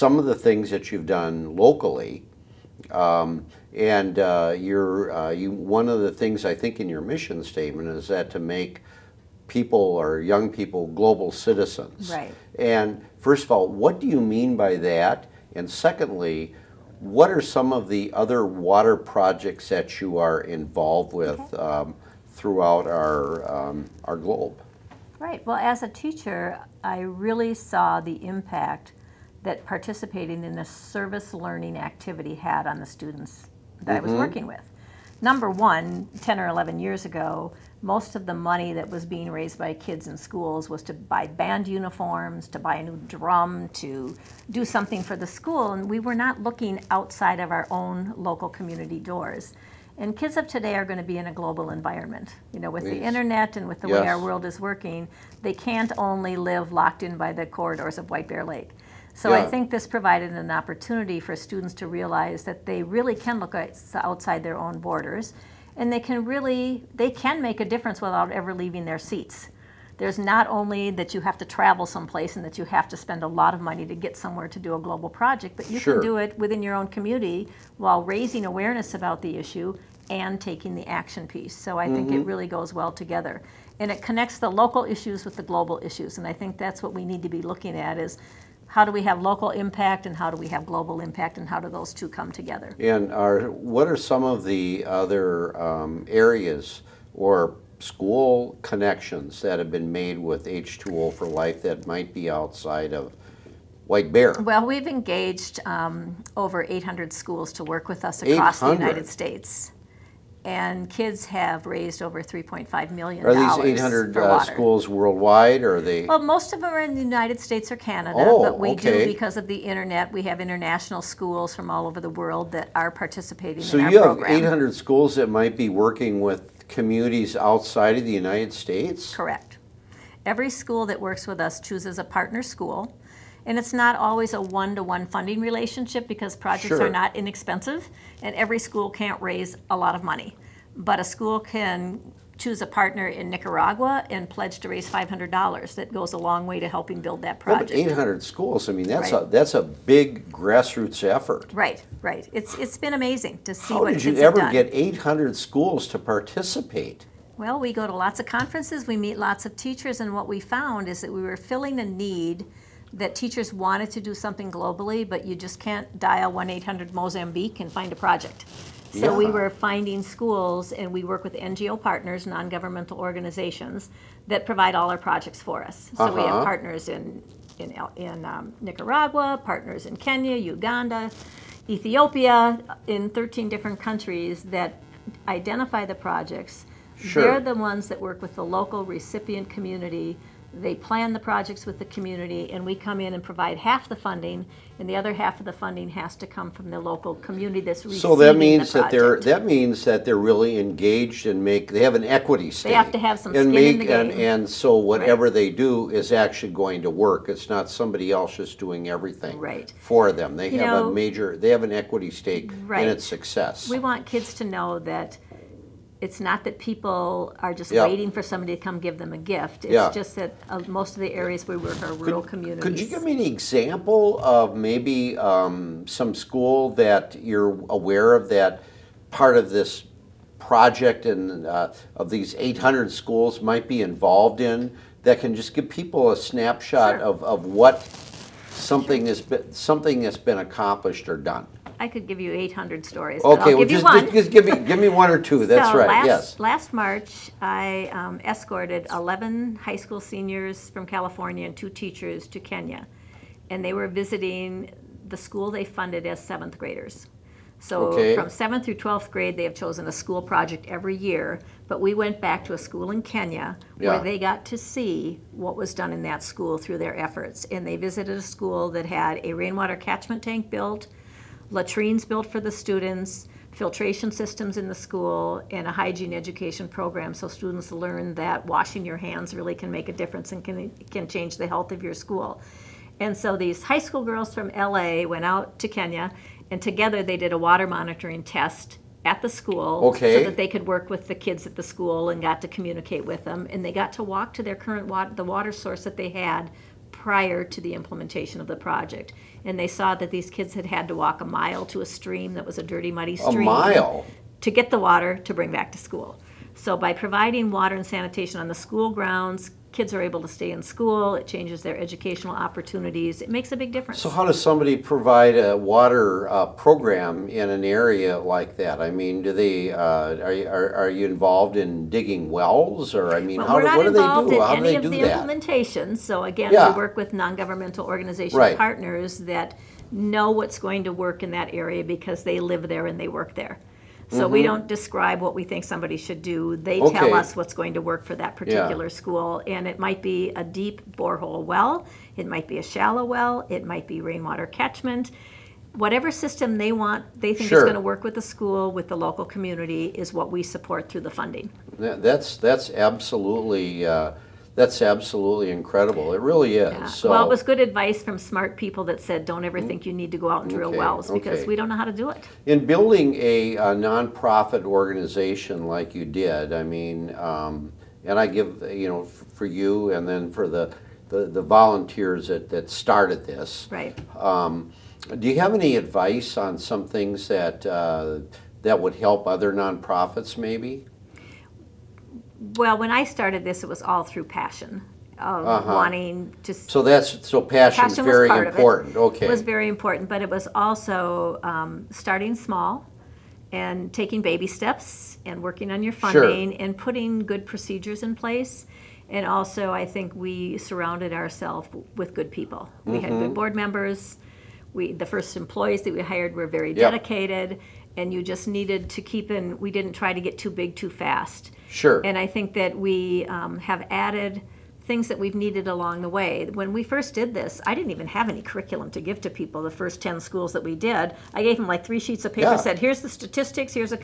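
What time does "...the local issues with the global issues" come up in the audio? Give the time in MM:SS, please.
01:24.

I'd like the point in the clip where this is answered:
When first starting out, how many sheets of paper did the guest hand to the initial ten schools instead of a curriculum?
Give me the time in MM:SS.
07:01.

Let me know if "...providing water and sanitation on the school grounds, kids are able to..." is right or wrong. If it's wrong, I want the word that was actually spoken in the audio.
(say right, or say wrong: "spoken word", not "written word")
right.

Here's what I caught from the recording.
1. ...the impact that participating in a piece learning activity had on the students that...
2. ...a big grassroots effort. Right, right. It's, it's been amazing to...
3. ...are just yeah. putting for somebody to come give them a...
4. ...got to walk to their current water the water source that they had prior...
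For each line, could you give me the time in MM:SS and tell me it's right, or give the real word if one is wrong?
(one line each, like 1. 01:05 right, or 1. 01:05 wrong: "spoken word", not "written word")
1. 00:28 wrong: "service", not "piece"
2. 02:29 right
3. 03:37 wrong: "waiting", not "putting"
4. 04:53 right.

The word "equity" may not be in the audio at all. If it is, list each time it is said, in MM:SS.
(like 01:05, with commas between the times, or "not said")
03:22, 03:31.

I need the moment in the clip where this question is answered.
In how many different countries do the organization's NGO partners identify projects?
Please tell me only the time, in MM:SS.
03:03.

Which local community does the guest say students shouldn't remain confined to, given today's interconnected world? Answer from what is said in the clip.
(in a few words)
White Bear Lake.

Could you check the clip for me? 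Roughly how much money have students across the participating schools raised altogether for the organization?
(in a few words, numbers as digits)
3.5 million.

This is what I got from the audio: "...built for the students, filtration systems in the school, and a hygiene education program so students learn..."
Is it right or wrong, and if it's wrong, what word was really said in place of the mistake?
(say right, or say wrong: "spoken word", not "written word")
right.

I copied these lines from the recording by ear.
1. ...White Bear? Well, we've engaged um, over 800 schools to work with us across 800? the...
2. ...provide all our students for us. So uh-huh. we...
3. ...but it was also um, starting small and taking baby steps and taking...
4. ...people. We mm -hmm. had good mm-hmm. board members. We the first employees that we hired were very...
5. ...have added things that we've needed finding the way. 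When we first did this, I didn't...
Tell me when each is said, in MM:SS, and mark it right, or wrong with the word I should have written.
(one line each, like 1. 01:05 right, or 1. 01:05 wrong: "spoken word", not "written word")
1. 01:43 right
2. 02:54 wrong: "projects", not "students"
3. 06:30 wrong: "working", not "taking"
4. 06:42 right
5. 06:53 wrong: "along", not "finding".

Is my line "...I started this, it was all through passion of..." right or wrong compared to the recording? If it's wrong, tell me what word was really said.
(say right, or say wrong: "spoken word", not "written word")
right.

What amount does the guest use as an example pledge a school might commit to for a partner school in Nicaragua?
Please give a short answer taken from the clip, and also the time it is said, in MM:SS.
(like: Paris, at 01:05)
$500, at 02:24.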